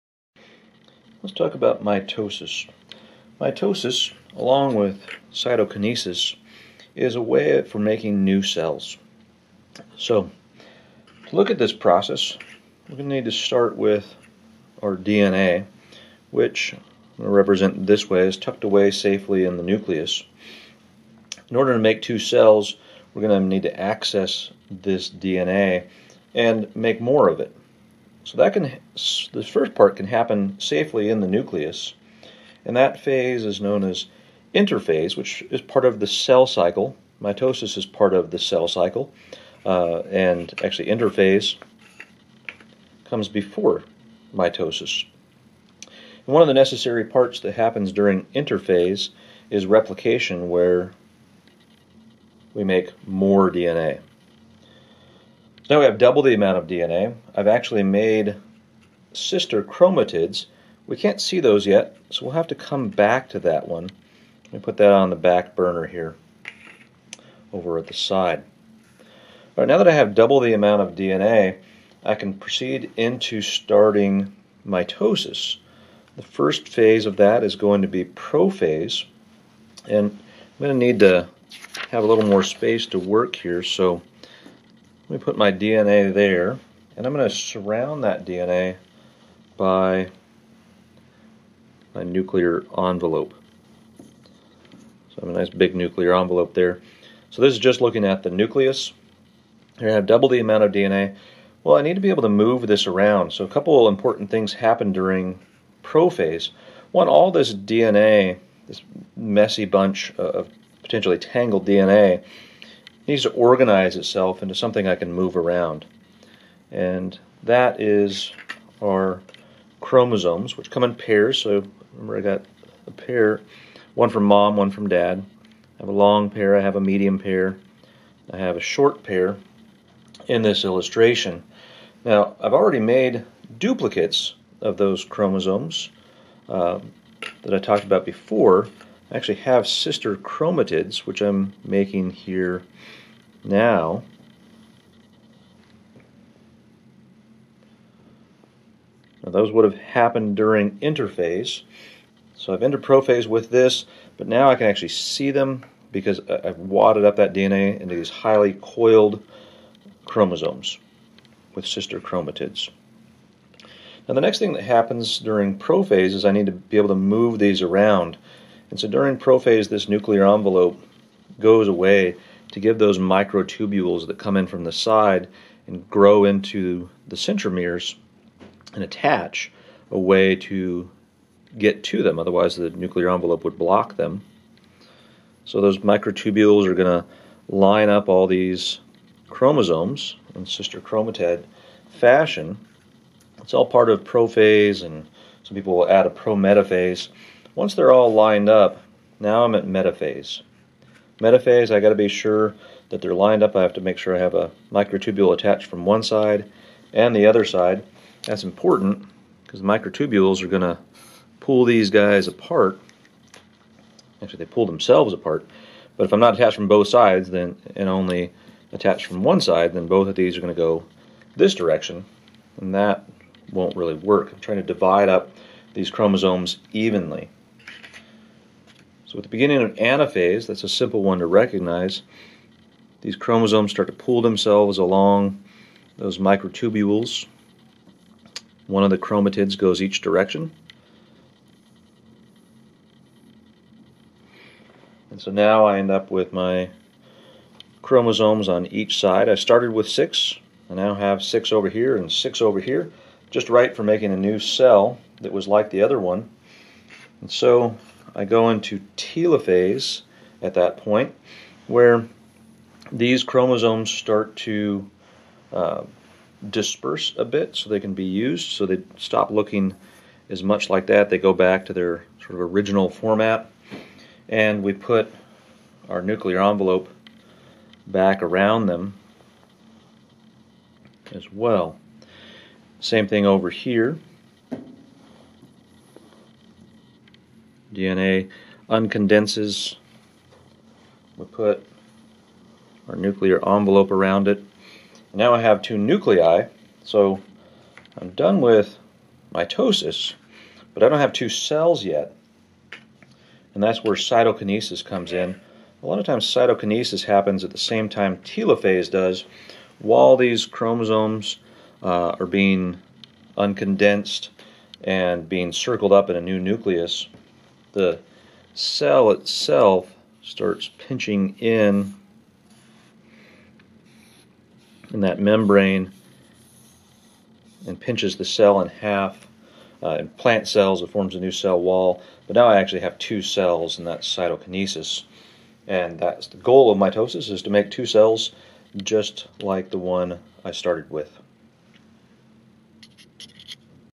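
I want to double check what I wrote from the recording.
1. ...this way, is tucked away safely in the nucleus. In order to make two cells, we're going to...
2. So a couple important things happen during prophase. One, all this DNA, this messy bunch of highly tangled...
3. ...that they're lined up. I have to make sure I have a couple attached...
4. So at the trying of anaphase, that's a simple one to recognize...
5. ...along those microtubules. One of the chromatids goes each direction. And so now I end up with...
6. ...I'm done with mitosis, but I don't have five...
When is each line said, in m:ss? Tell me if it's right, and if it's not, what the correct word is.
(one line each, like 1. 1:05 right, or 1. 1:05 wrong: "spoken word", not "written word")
1. 0:17 right
2. 1:43 wrong: "potentially", not "highly"
3. 3:22 wrong: "microtubule", not "couple"
4. 3:49 wrong: "beginning", not "trying"
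5. 3:54 right
6. 4:57 wrong: "two", not "five".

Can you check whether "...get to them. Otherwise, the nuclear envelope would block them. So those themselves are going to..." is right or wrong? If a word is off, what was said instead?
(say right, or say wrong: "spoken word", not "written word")
wrong: "microtubules", not "themselves".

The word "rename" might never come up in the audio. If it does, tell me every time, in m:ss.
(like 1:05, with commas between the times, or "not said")
not said.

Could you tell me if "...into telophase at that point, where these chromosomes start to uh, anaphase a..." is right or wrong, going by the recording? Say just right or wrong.
wrong.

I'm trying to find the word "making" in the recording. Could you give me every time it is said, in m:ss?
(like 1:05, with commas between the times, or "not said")
0:07, 2:21, 4:13.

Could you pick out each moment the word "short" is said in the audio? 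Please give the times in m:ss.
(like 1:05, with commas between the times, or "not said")
2:08.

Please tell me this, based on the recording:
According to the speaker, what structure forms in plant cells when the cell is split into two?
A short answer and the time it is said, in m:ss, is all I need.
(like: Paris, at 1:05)
a new cell wall, at 5:31.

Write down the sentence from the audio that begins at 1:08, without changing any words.
All right, now that I have double the amount of DNA, I can proceed into starting mitosis.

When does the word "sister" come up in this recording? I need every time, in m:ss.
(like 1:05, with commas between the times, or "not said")
0:59, 2:19, 2:41, 3:10.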